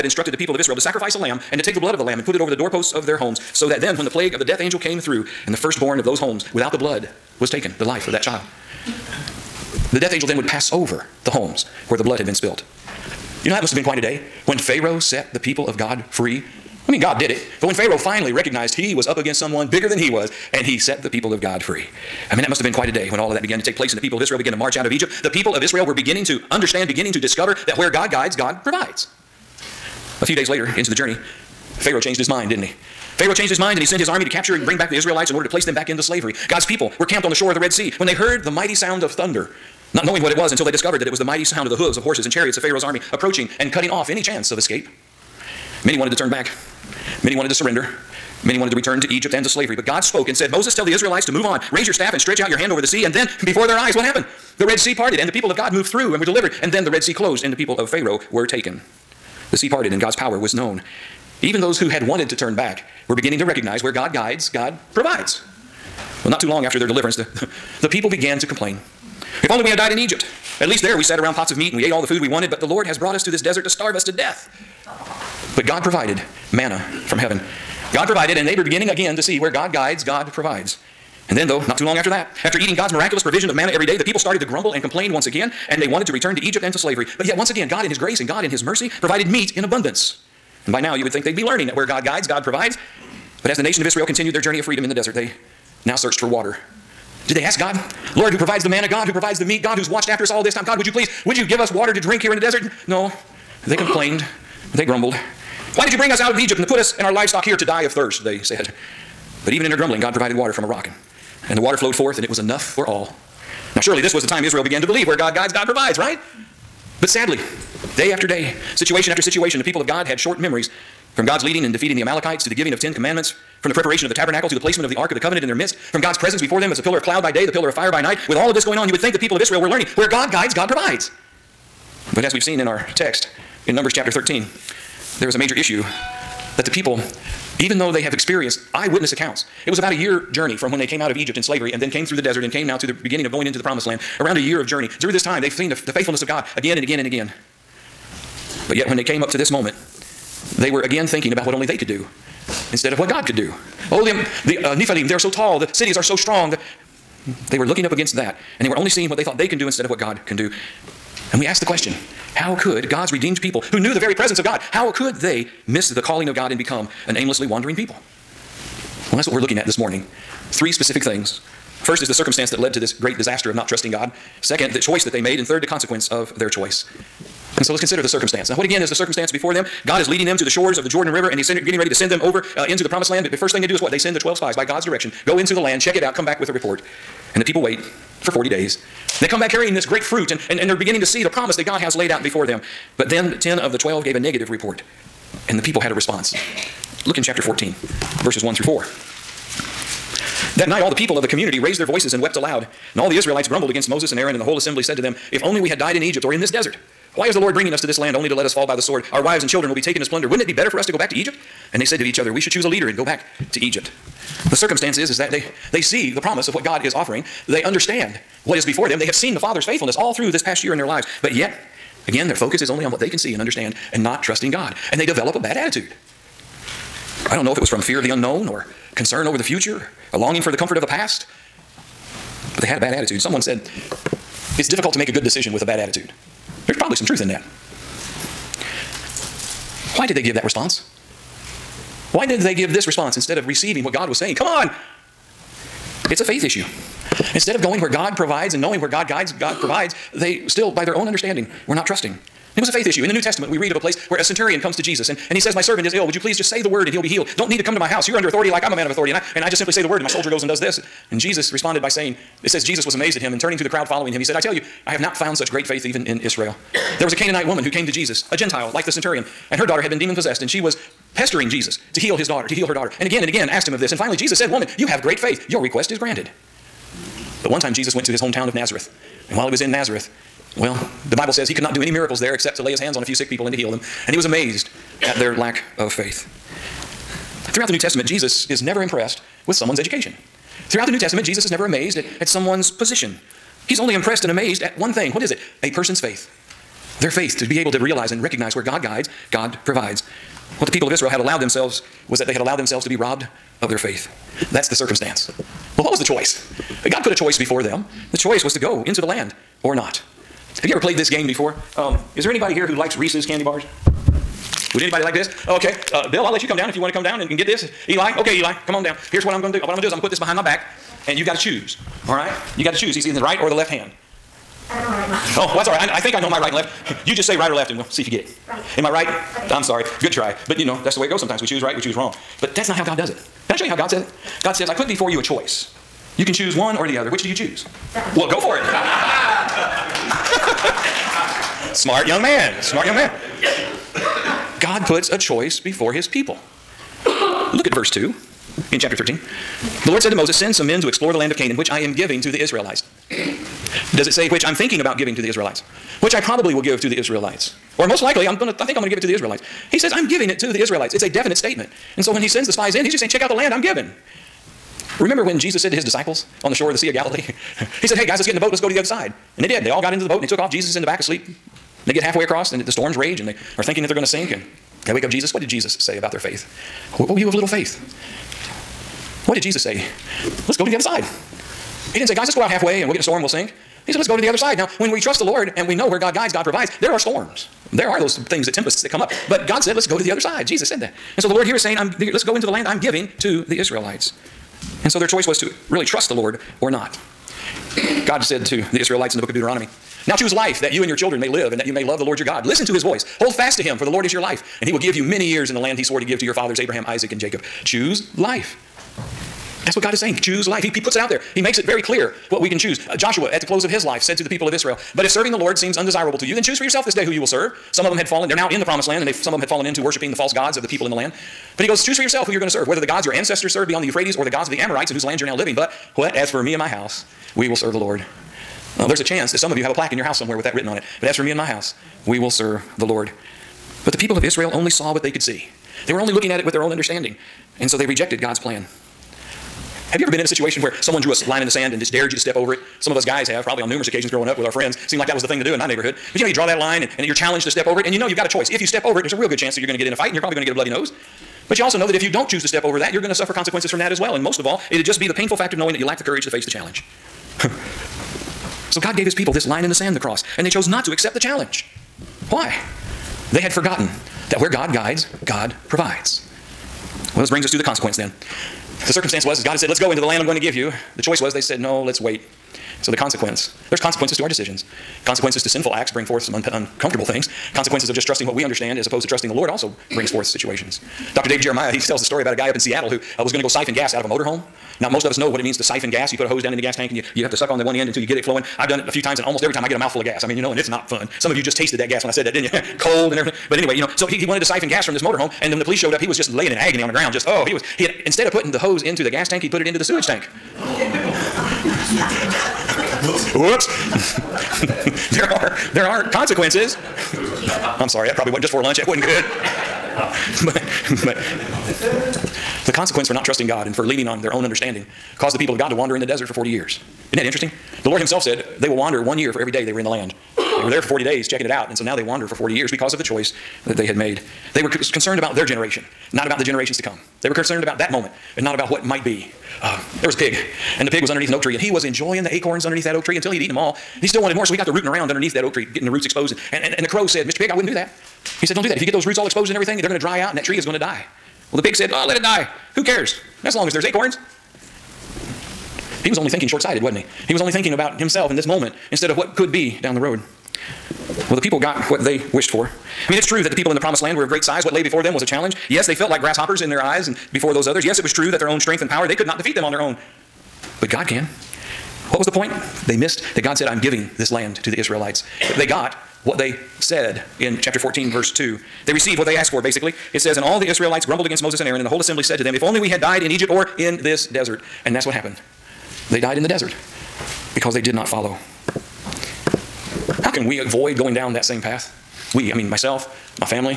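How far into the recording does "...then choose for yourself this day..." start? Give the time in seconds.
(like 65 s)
416 s.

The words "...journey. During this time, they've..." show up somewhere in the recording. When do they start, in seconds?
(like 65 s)
144 s.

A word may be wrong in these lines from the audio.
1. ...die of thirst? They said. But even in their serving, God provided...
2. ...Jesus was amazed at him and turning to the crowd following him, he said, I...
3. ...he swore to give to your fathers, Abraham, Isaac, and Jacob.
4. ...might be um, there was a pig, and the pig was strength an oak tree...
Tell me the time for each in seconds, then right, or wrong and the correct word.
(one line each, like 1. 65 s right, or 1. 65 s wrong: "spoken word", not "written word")
1. 107 s wrong: "grumbling", not "serving"
2. 262 s right
3. 405 s right
4. 528 s wrong: "underneath", not "strength".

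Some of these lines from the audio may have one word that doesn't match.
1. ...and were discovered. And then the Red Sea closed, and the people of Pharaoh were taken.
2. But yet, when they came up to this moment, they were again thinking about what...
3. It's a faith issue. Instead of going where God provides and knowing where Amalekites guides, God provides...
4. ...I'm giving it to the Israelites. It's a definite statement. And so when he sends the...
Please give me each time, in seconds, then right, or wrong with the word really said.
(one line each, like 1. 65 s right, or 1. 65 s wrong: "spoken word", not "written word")
1. 56 s wrong: "delivered", not "discovered"
2. 148 s right
3. 246 s wrong: "God", not "Amalekites"
4. 359 s right.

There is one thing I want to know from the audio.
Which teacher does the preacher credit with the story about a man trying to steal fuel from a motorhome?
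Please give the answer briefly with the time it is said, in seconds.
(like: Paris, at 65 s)
Dave Jeremiah, at 481 s.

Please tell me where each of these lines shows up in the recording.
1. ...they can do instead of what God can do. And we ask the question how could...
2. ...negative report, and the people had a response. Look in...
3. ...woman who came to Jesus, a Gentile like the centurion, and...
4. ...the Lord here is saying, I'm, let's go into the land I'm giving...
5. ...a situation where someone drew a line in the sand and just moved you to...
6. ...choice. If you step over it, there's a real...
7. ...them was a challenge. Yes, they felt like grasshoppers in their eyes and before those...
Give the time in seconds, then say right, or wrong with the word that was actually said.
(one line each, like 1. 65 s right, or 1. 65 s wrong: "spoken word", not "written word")
1. 159 s right
2. 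194 s right
3. 267 s right
4. 391 s right
5. 440 s wrong: "dared", not "moved"
6. 448 s right
7. 555 s right.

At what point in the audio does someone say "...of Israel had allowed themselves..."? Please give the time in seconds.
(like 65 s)
300 s.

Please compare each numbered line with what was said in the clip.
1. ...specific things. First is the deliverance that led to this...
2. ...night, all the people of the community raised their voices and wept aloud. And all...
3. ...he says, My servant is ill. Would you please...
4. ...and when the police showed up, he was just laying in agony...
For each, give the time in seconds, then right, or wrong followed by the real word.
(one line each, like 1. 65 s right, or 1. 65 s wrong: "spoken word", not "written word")
1. 170 s wrong: "circumstance", not "deliverance"
2. 200 s right
3. 255 s right
4. 495 s right.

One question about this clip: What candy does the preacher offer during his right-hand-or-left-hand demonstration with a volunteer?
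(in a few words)
Reese's.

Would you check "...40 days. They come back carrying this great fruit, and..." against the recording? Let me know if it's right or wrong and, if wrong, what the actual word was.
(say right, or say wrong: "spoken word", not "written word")
right.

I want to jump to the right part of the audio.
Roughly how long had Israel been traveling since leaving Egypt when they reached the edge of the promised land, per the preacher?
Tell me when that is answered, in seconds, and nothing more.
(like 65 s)
139 s.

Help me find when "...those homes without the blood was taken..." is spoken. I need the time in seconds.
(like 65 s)
6 s.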